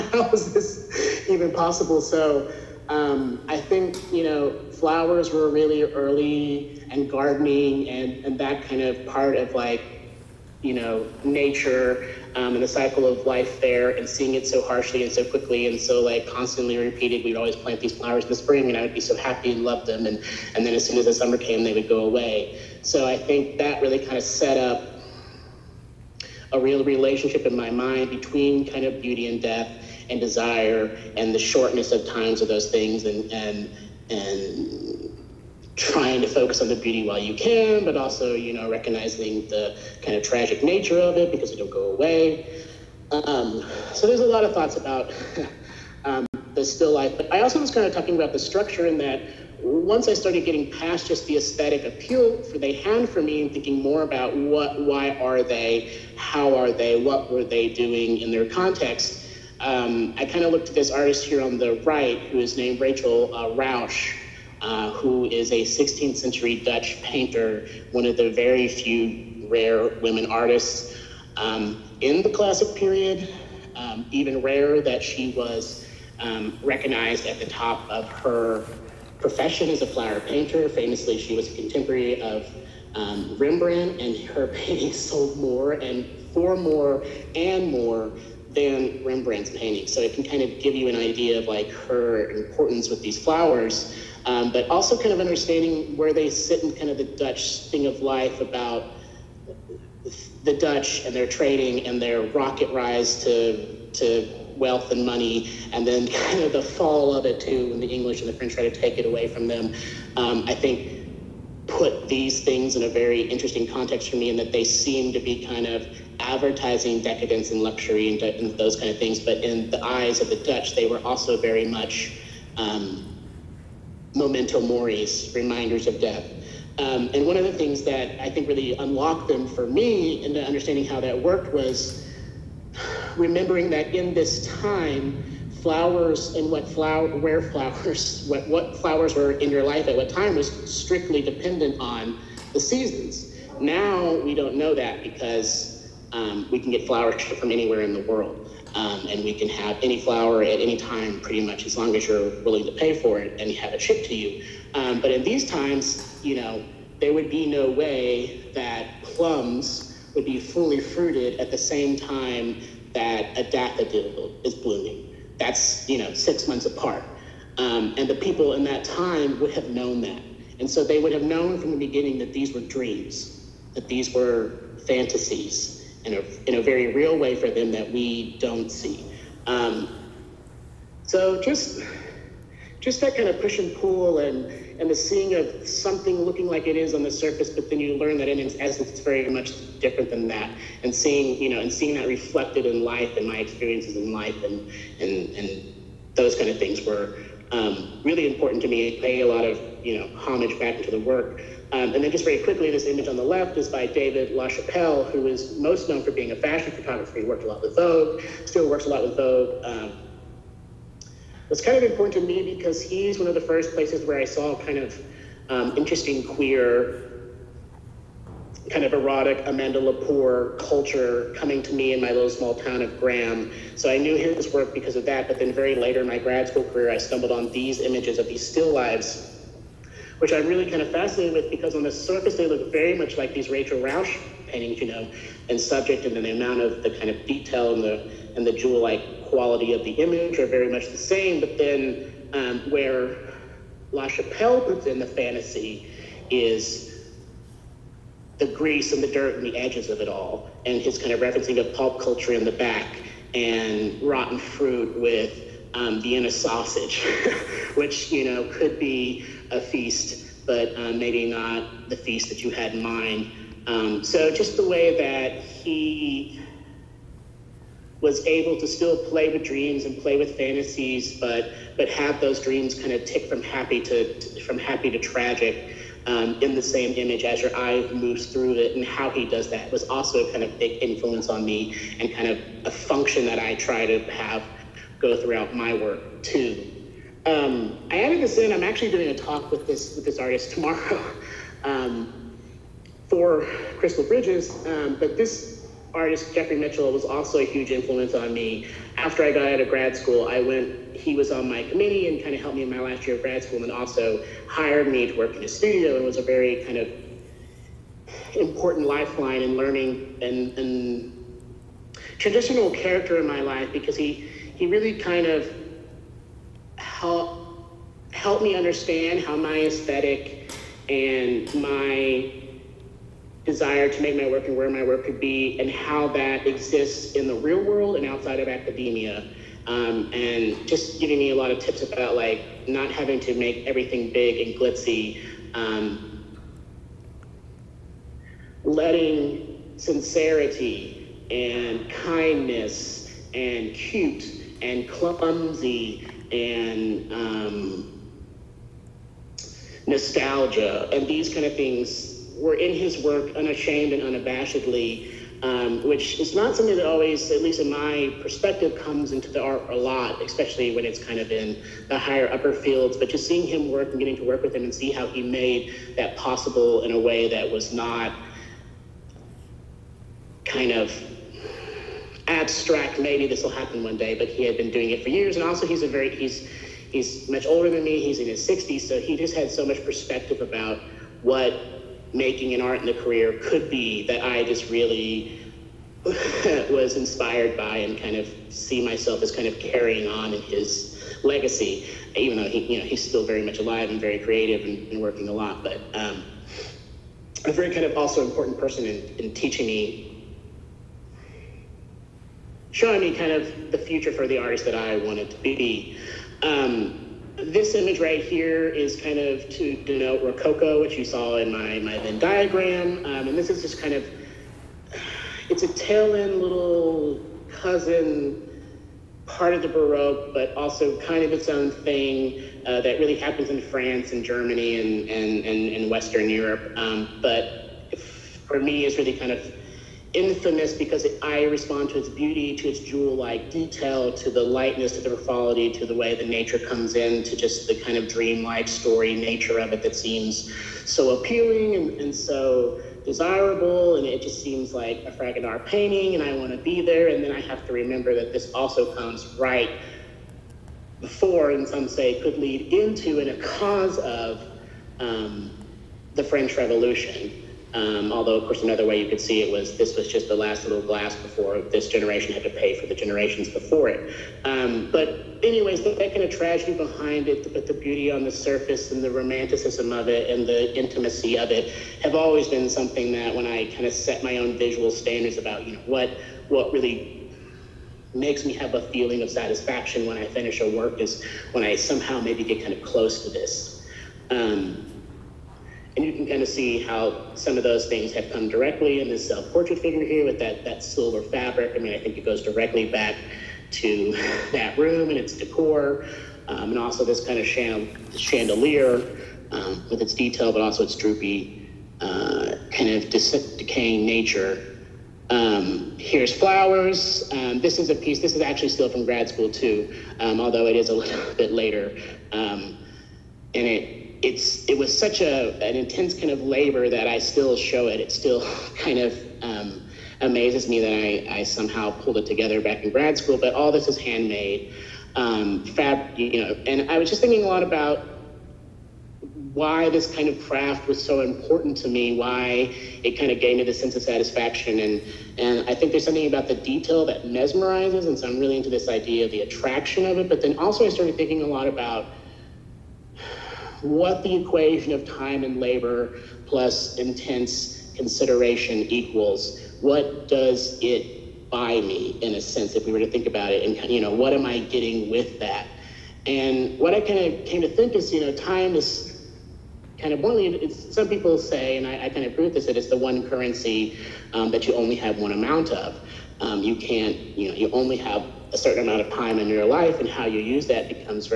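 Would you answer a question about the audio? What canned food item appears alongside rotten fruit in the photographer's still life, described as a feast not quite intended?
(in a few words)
Vienna sausage.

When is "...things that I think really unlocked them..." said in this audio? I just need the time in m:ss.
2:07.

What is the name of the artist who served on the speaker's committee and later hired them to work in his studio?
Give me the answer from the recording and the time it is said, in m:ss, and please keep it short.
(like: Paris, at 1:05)
Jeffrey Mitchell, at 4:56.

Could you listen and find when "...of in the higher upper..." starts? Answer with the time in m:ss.
6:01.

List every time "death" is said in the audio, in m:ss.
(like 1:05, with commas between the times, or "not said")
0:29, 2:05.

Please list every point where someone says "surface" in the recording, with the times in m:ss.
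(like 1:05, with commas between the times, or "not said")
3:07, 3:51, 7:48.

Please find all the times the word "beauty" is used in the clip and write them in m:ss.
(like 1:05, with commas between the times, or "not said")
0:29, 0:36, 7:12, 7:47.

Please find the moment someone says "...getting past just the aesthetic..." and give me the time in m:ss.
0:50.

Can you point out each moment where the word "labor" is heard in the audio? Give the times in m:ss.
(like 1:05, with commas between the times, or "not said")
8:36, 9:05.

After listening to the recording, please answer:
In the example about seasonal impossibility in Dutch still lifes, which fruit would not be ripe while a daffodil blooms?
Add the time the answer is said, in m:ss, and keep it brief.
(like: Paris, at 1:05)
Plums, at 2:39.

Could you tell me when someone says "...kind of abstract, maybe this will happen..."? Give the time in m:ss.
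6:10.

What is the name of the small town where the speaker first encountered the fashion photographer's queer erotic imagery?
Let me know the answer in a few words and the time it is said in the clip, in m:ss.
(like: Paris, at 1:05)
Graham, at 3:42.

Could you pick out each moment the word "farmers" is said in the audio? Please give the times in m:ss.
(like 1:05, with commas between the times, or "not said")
not said.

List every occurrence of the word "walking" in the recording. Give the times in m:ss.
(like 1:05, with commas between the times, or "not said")
not said.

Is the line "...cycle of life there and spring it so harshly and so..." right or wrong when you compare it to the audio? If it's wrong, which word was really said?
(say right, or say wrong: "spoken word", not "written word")
wrong: "seeing", not "spring".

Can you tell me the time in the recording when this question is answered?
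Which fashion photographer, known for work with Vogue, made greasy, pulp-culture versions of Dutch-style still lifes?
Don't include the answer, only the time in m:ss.
3:23.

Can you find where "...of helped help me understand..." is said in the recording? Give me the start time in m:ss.
5:15.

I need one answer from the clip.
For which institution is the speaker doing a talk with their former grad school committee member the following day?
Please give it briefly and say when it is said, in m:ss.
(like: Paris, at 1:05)
Crystal Bridges, at 4:53.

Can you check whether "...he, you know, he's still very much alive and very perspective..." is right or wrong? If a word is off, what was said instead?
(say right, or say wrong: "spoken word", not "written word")
wrong: "creative", not "perspective".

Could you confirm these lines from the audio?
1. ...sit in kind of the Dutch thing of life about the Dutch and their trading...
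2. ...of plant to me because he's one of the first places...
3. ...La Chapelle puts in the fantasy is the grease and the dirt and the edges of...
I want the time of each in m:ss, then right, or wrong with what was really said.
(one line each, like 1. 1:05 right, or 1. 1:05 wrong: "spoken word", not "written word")
1. 1:36 right
2. 3:31 wrong: "important", not "plant"
3. 4:03 right.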